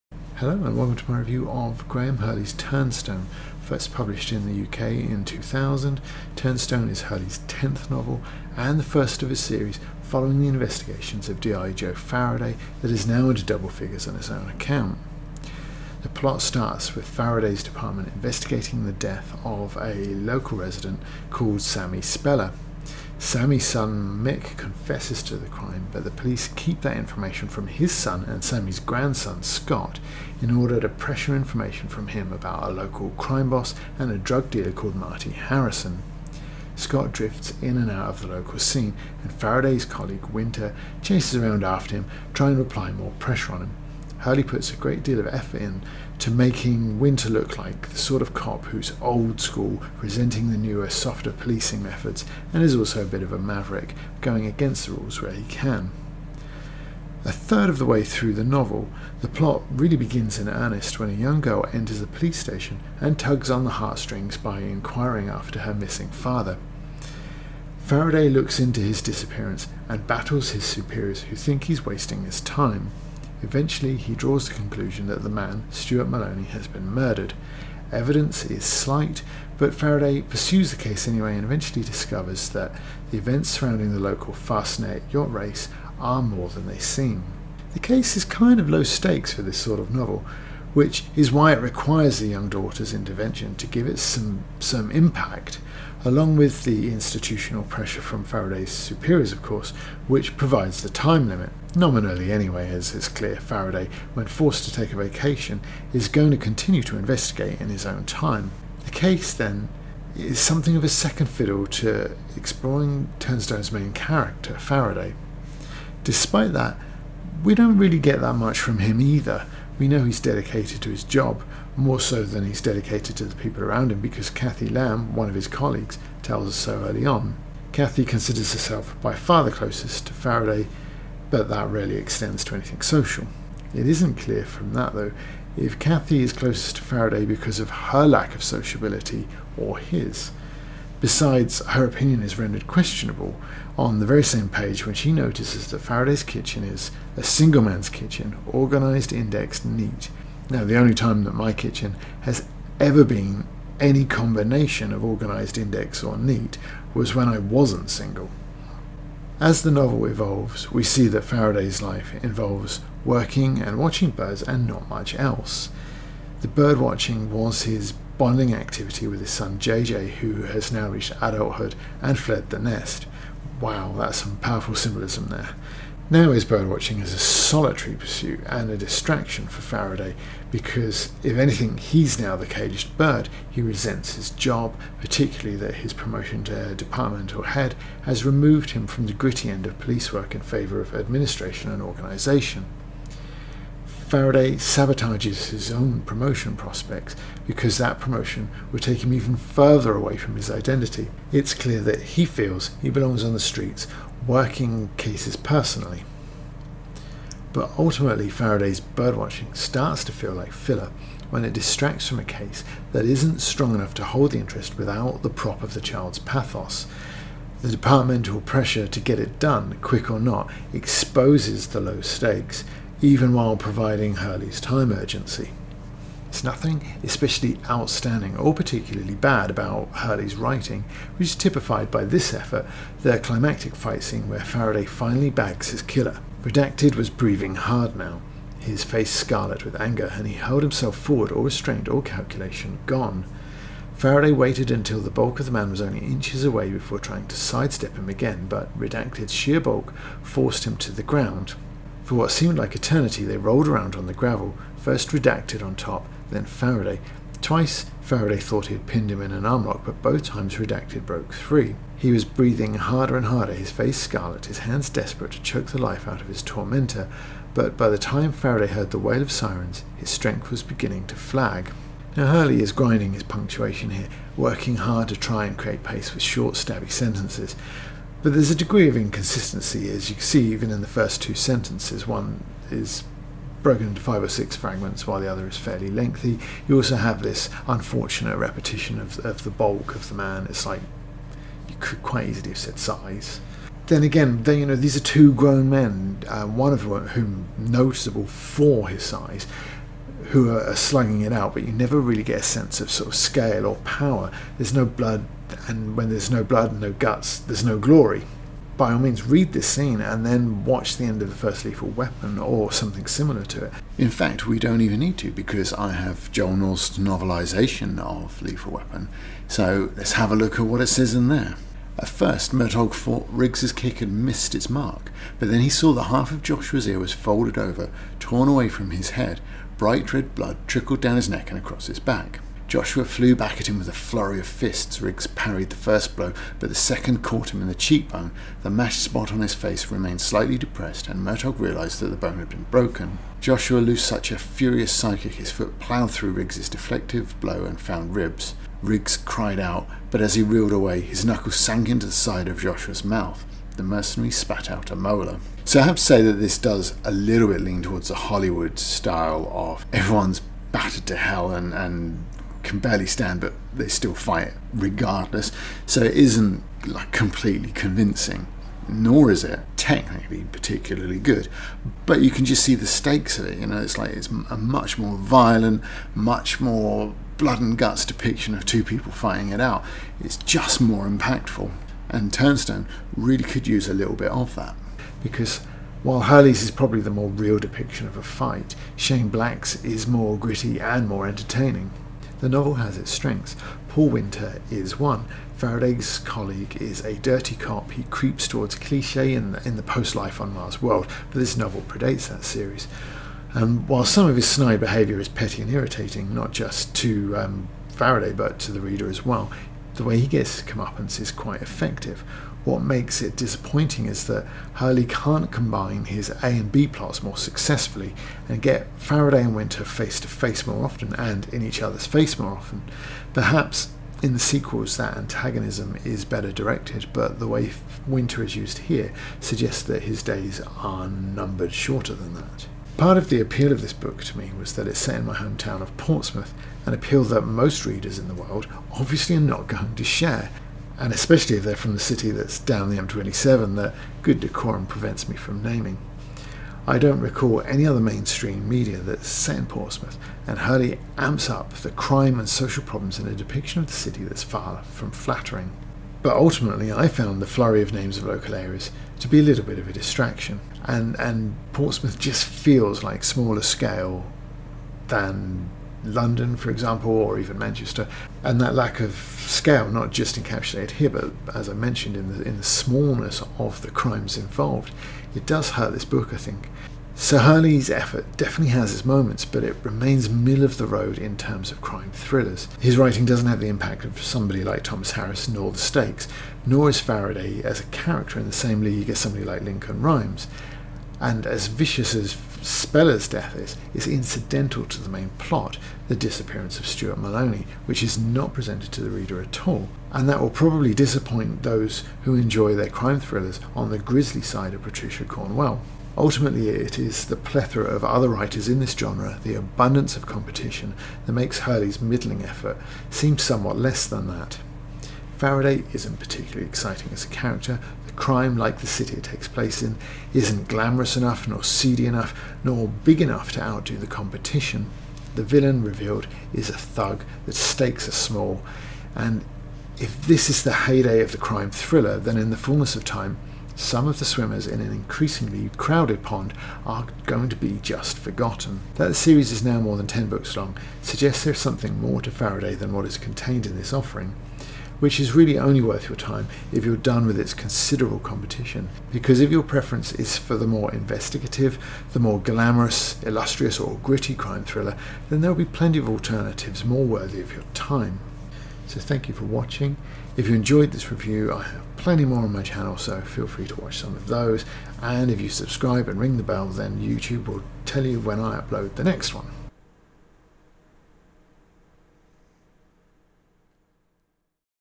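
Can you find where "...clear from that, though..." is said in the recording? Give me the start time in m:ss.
2:14.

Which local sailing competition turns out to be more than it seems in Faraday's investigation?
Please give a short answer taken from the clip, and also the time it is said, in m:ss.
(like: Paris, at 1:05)
Fastnet yacht race, at 1:24.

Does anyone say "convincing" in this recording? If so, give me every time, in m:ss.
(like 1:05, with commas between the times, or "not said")
6:07.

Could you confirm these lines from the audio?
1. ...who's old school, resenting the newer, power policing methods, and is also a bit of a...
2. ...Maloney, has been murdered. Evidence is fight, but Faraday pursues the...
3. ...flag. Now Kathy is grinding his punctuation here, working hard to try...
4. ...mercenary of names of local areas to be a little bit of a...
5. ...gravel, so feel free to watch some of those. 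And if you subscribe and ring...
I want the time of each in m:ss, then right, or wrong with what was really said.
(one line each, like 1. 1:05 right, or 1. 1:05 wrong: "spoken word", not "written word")
1. 0:48 wrong: "softer", not "power"
2. 1:16 wrong: "slight", not "fight"
3. 4:31 wrong: "Hurley", not "Kathy"
4. 7:37 wrong: "flurry", not "mercenary"
5. 9:22 wrong: "channel", not "gravel".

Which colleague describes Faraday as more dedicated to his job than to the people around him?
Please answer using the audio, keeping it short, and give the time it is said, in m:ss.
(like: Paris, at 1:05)
Kathy Lamb, at 2:04.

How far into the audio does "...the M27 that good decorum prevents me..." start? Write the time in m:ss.
7:22.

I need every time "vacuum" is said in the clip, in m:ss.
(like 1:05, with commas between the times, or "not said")
not said.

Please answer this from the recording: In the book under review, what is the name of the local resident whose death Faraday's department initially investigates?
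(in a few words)
Sammy Speller.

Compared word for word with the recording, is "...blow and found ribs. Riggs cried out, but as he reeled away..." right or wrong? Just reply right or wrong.
right.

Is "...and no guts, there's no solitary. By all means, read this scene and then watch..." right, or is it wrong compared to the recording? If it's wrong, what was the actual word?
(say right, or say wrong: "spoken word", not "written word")
wrong: "glory", not "solitary".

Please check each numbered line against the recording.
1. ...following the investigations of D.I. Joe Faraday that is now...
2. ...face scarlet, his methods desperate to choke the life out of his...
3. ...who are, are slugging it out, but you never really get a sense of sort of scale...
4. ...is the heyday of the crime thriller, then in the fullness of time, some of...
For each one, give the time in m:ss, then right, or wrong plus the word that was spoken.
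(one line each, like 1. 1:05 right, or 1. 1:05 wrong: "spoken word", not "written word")
1. 0:10 right
2. 4:23 wrong: "hands", not "methods"
3. 5:00 right
4. 8:50 right.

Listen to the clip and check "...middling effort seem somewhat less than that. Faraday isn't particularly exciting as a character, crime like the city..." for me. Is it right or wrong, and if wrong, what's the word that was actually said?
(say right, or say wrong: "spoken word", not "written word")
right.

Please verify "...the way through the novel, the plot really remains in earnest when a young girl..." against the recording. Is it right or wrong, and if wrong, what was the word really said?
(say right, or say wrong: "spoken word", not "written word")
wrong: "begins", not "remains".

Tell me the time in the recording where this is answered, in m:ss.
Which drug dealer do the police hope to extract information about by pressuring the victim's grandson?
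0:34.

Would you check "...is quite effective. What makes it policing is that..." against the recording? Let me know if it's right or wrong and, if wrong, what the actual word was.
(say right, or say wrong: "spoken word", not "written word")
wrong: "disappointing", not "policing".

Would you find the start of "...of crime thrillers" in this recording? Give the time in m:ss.
8:01.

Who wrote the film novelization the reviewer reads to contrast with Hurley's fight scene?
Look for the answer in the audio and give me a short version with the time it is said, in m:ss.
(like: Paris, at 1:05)
Joel Norst, at 5:16.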